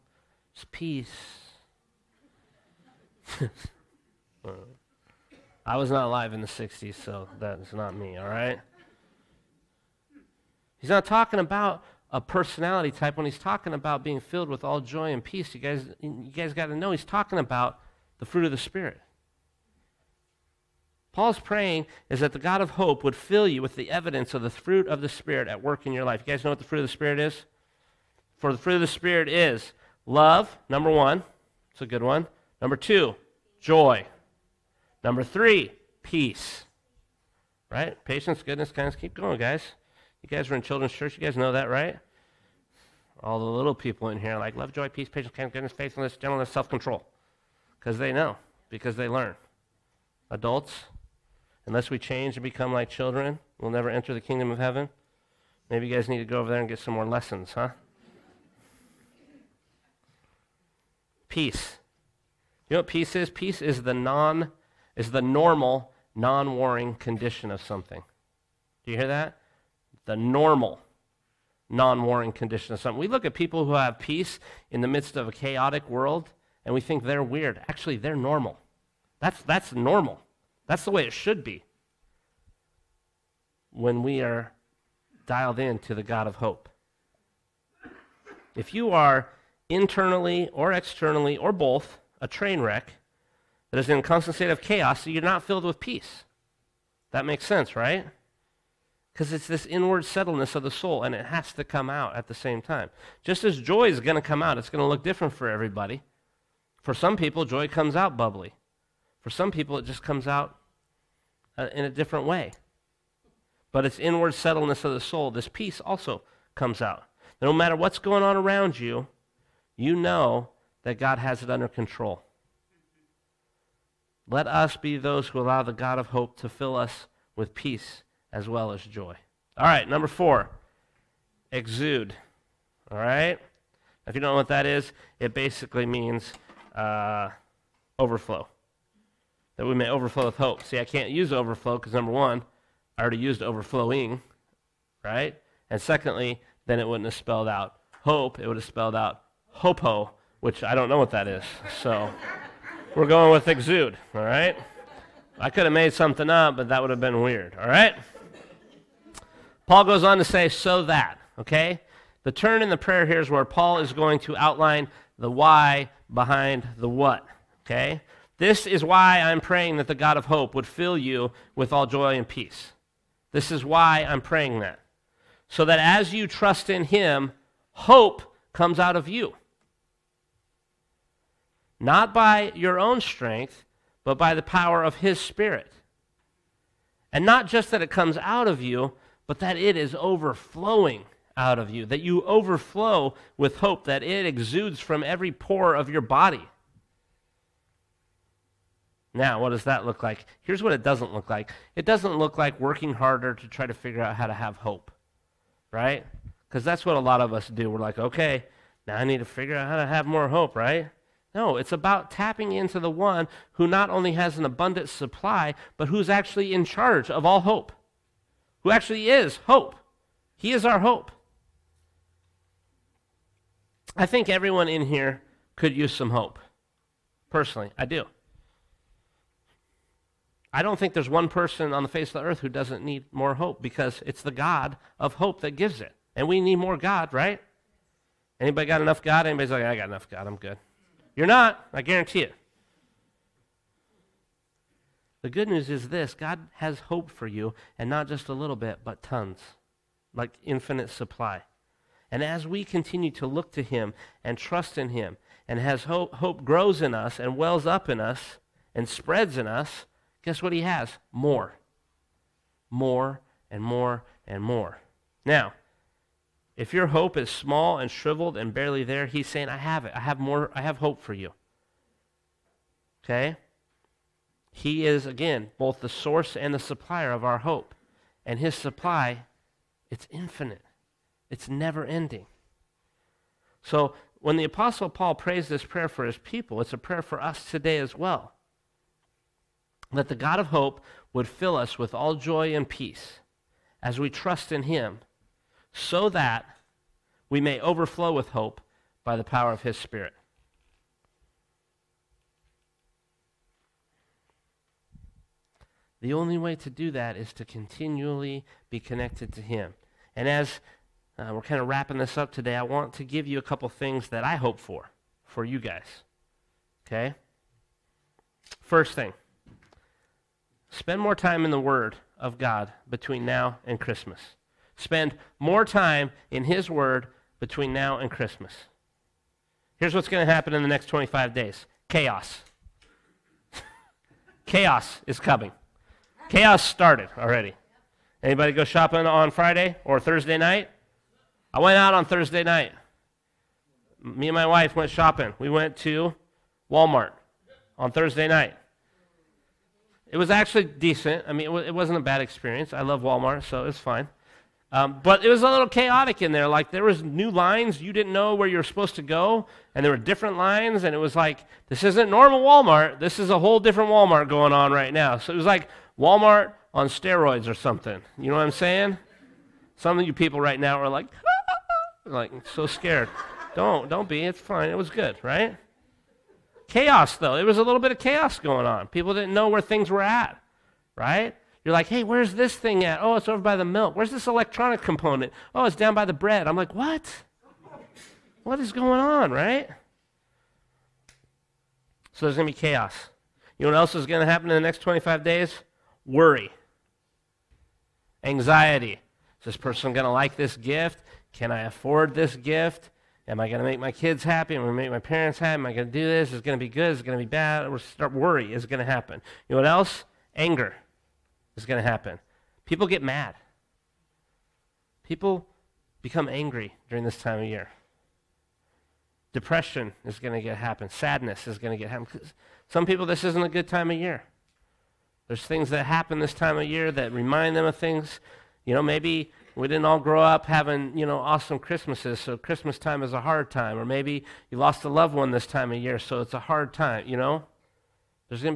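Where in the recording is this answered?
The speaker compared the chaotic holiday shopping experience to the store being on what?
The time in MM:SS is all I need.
06:06.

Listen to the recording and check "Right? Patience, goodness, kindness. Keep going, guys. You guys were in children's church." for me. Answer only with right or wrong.
right.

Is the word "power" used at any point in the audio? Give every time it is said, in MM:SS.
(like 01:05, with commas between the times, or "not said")
03:04, 04:59.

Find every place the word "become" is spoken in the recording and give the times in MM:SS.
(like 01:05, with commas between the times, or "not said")
00:52, 06:56.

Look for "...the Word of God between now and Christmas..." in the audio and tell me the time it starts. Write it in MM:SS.
05:21.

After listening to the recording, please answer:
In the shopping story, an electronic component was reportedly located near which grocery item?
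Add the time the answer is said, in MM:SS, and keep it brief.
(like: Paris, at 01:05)
bread, at 06:26.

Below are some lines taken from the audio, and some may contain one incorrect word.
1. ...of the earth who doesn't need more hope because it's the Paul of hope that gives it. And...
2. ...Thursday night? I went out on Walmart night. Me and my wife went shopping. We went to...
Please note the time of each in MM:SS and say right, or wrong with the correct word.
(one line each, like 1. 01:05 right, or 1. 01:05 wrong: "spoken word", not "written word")
1. 03:52 wrong: "God", not "Paul"
2. 05:39 wrong: "Thursday", not "Walmart".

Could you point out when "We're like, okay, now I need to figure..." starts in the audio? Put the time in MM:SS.
03:27.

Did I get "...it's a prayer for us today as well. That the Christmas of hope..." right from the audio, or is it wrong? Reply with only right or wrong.
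wrong.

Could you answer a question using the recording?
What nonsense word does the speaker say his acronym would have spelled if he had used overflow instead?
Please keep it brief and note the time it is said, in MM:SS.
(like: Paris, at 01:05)
hopo, at 02:29.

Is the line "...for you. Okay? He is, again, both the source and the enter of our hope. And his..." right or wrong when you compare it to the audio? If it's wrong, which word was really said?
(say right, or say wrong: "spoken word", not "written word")
wrong: "supplier", not "enter".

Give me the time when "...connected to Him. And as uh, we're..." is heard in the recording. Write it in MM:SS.
05:08.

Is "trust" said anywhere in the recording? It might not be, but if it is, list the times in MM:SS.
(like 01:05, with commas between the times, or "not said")
02:56, 04:14, 04:54.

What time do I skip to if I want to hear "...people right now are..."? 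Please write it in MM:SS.
06:10.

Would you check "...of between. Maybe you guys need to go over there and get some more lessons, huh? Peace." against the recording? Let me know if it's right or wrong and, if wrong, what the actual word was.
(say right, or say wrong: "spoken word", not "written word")
wrong: "heaven", not "between".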